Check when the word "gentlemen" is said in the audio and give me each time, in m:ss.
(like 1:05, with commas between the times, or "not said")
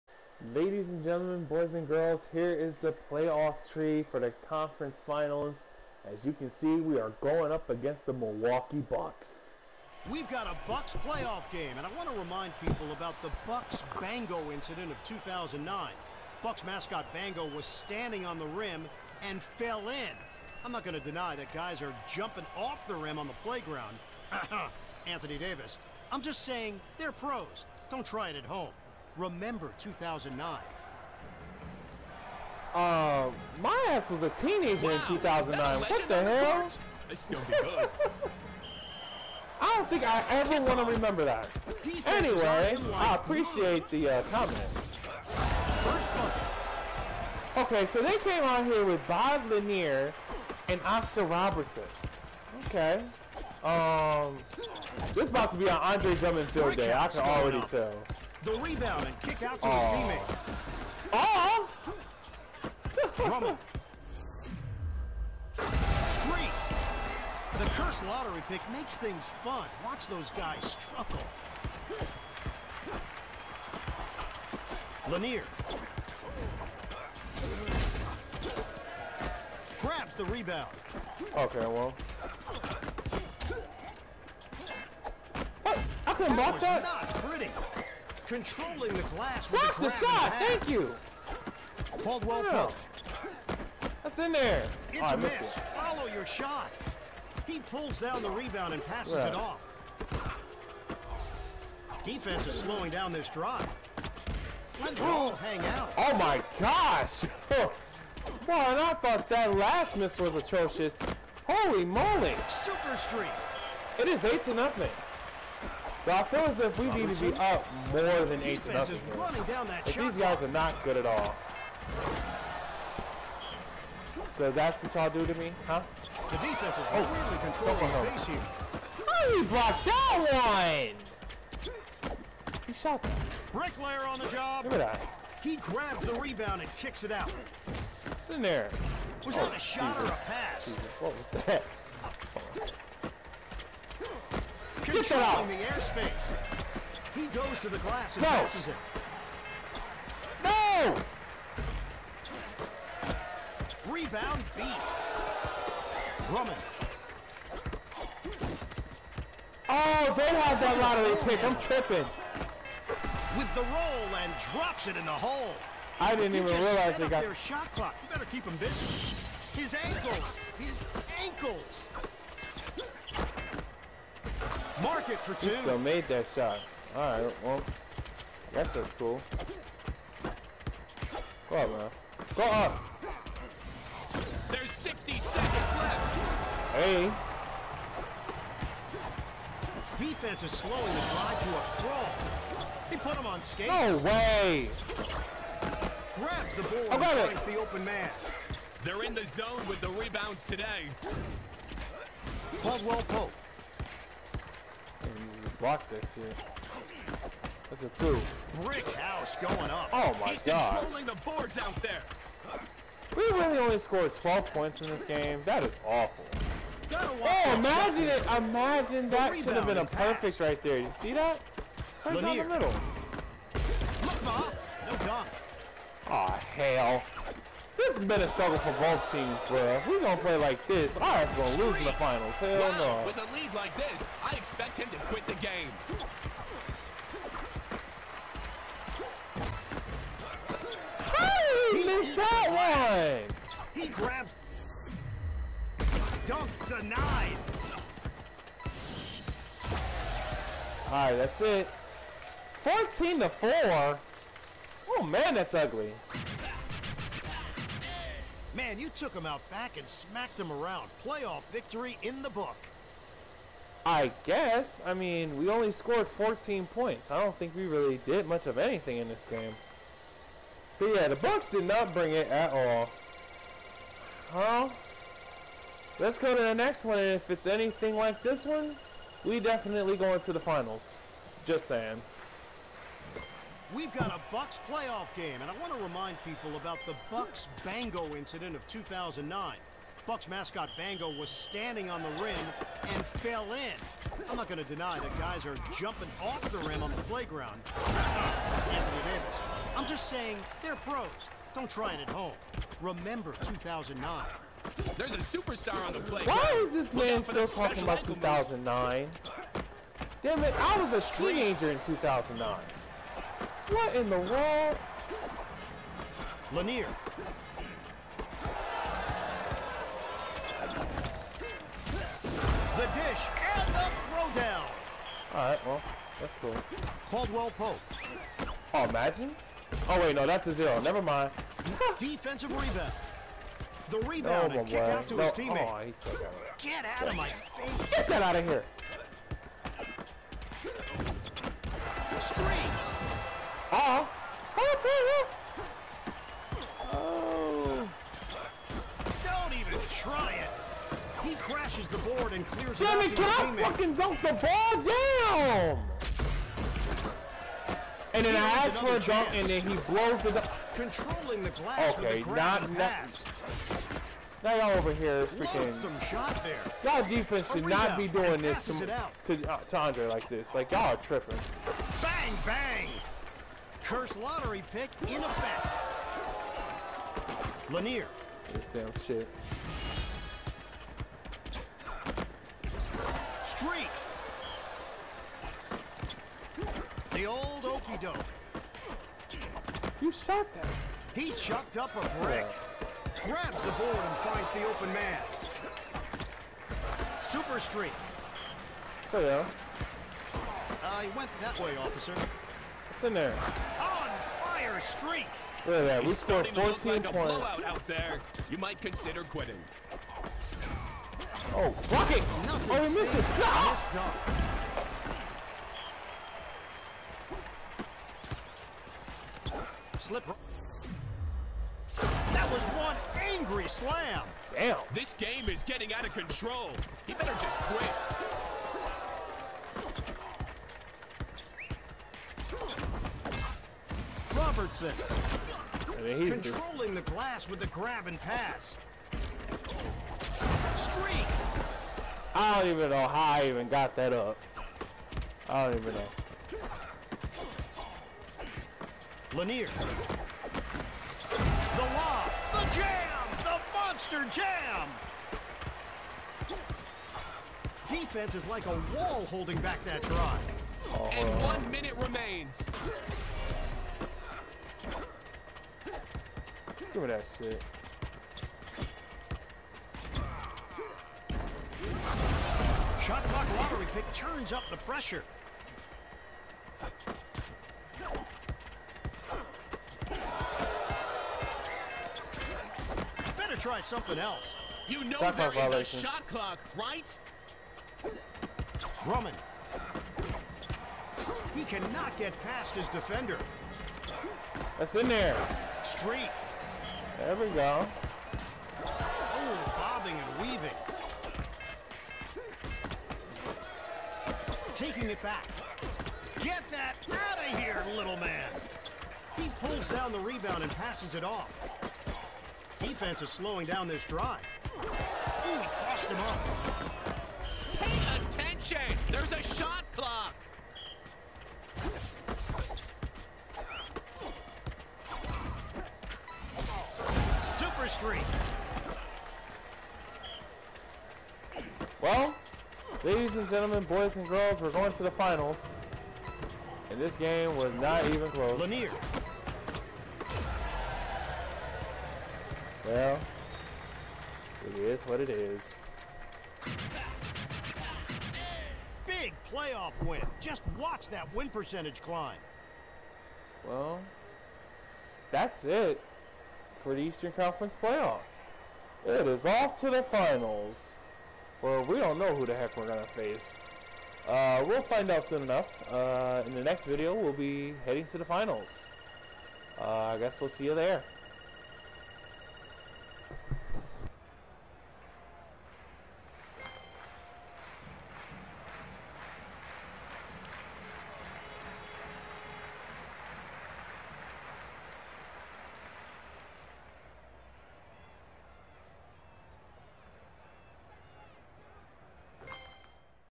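0:01, 8:53.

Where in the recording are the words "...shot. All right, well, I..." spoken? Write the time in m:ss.
2:56.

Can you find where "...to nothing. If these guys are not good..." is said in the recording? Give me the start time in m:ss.
1:58.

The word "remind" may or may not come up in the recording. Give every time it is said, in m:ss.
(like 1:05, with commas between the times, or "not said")
0:12, 4:45.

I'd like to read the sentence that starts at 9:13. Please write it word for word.
Well, that's it for the Eastern Conference playoffs.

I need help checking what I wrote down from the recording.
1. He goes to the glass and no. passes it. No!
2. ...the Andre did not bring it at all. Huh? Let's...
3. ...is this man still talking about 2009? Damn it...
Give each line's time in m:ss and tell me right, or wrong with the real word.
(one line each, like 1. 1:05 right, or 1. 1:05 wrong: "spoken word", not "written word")
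1. 2:27 right
2. 4:31 wrong: "Bucks", not "Andre"
3. 5:06 right.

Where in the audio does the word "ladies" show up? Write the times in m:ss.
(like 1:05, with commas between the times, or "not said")
0:00, 8:53.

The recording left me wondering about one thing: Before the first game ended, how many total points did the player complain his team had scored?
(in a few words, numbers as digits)
12.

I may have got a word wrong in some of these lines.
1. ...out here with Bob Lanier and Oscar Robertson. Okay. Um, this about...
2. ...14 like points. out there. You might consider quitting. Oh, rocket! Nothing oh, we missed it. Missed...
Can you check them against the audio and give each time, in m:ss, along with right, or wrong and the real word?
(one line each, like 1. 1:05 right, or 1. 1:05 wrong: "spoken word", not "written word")
1. 0:48 right
2. 6:46 right.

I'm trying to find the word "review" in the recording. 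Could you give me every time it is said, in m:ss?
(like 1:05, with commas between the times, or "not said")
not said.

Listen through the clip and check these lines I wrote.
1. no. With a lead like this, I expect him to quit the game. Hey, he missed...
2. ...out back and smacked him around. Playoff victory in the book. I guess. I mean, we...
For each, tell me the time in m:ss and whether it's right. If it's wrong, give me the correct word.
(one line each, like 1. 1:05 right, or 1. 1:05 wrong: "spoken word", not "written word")
1. 3:53 right
2. 4:19 right.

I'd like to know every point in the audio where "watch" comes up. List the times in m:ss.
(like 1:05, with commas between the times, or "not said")
1:09, 9:10.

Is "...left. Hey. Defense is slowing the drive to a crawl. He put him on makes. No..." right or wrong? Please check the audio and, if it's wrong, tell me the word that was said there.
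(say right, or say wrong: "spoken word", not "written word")
wrong: "skates", not "makes".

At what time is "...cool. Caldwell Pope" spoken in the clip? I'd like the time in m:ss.
5:26.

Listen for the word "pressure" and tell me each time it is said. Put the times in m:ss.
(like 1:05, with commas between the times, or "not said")
7:54.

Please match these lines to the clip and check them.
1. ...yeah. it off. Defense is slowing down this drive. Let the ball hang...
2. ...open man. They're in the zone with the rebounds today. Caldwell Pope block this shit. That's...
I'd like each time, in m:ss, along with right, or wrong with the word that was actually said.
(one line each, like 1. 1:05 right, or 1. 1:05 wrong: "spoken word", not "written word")
1. 1:39 right
2. 3:17 right.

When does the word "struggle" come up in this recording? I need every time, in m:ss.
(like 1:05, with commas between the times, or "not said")
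1:10, 3:48.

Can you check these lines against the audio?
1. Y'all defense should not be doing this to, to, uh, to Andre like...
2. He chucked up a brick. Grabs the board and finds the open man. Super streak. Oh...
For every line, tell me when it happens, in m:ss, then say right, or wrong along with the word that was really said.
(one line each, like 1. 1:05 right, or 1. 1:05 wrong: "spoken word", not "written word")
1. 6:06 right
2. 6:31 right.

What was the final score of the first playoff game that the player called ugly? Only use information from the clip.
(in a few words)
14 to 4.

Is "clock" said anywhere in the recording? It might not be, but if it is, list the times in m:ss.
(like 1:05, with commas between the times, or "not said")
2:47, 7:53, 8:06, 8:39.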